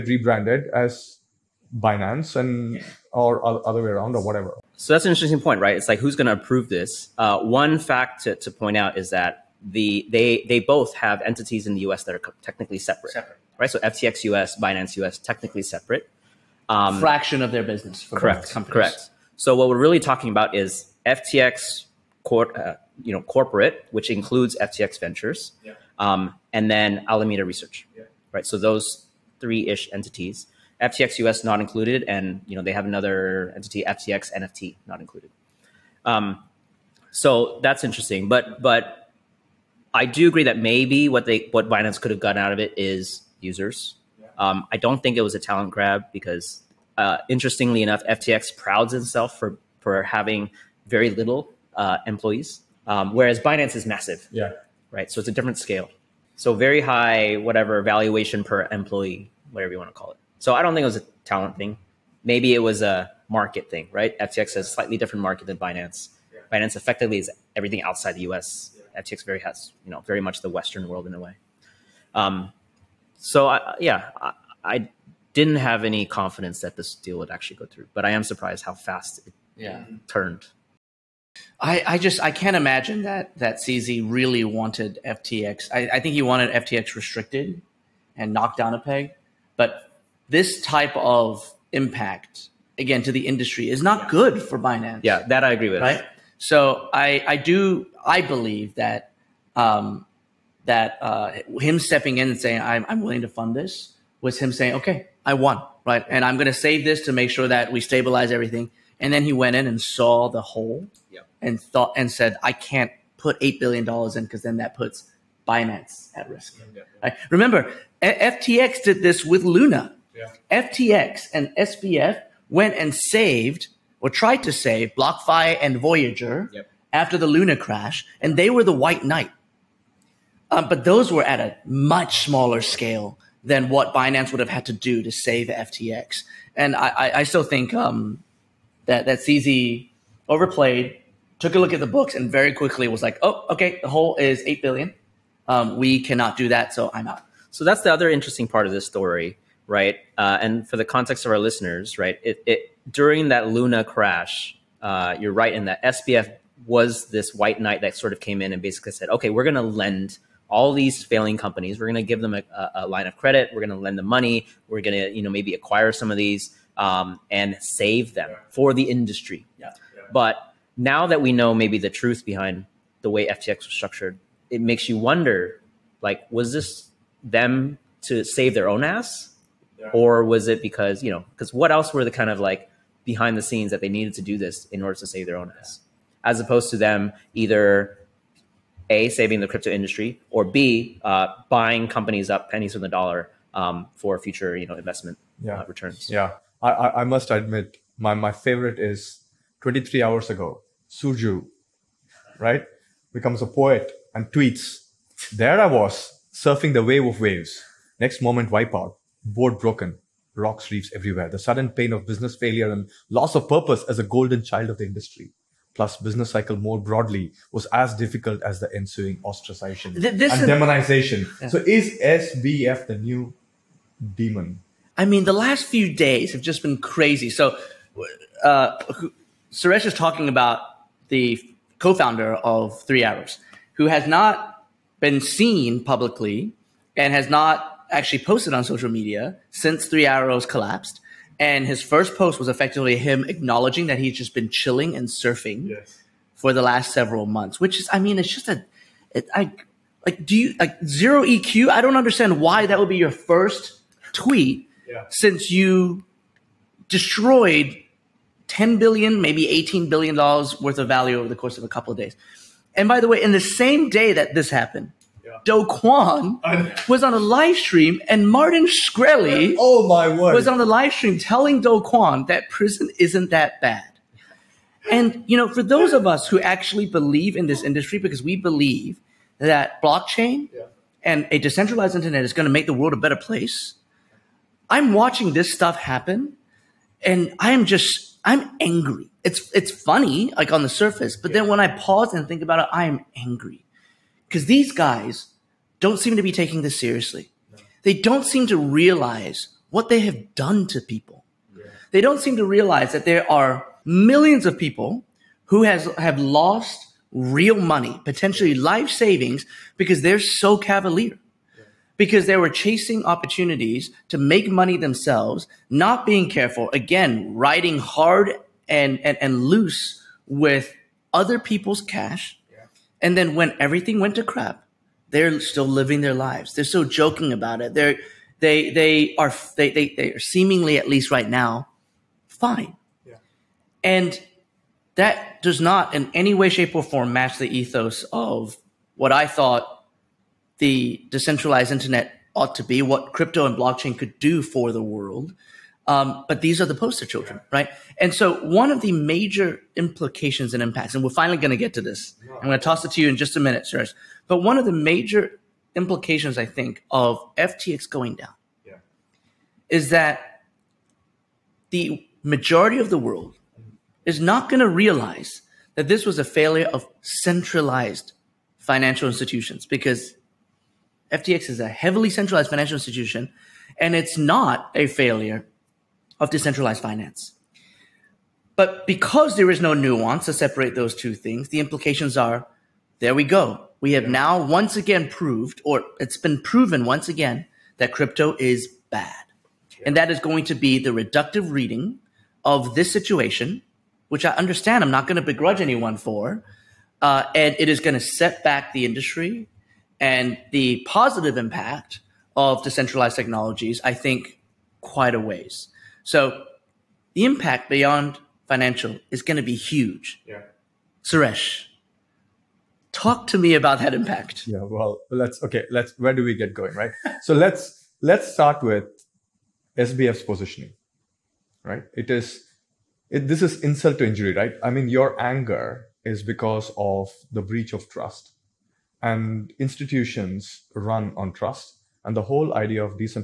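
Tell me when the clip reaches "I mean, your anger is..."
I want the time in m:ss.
7:04.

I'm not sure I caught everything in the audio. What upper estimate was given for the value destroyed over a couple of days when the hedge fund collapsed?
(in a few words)
18 billion dollars.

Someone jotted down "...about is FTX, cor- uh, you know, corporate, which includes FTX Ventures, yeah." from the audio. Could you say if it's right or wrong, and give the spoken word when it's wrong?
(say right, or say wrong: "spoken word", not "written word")
right.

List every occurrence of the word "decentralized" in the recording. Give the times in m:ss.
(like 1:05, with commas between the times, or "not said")
4:41, 5:41, 6:16, 6:42.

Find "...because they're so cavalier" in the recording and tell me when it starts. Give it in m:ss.
5:09.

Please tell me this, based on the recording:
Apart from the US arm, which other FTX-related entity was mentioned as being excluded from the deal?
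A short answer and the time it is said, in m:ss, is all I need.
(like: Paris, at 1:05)
FTX NFT, at 0:33.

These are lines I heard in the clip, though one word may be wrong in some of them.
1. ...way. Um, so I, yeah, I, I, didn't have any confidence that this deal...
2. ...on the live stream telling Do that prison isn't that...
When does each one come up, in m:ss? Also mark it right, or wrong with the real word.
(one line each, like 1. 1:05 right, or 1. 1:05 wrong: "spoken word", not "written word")
1. 1:11 right
2. 4:30 right.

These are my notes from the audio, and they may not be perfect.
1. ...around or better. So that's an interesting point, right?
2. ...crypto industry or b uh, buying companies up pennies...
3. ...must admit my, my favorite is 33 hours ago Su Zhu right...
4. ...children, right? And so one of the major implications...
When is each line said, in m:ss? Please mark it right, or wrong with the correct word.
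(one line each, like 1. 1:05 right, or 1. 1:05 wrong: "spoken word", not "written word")
1. 0:03 wrong: "whatever", not "better"
2. 3:09 right
3. 3:17 wrong: "23", not "33"
4. 5:47 right.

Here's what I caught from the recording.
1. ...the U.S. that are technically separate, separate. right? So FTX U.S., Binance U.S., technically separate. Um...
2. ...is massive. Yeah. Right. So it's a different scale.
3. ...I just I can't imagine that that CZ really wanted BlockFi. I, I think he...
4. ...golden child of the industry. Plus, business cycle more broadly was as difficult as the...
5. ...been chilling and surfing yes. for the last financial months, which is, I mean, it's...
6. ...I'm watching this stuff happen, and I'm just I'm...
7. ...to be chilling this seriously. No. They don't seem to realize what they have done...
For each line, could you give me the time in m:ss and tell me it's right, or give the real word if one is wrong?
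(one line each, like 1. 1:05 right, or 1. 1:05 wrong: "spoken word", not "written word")
1. 0:11 right
2. 0:53 right
3. 1:21 wrong: "FTX", not "BlockFi"
4. 3:34 right
5. 4:04 wrong: "several", not "financial"
6. 4:44 right
7. 4:56 wrong: "taking", not "chilling".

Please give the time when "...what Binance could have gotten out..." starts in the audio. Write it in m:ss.
0:41.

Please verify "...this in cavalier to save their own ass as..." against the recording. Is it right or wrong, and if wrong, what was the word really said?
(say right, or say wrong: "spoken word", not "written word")
wrong: "order", not "cavalier".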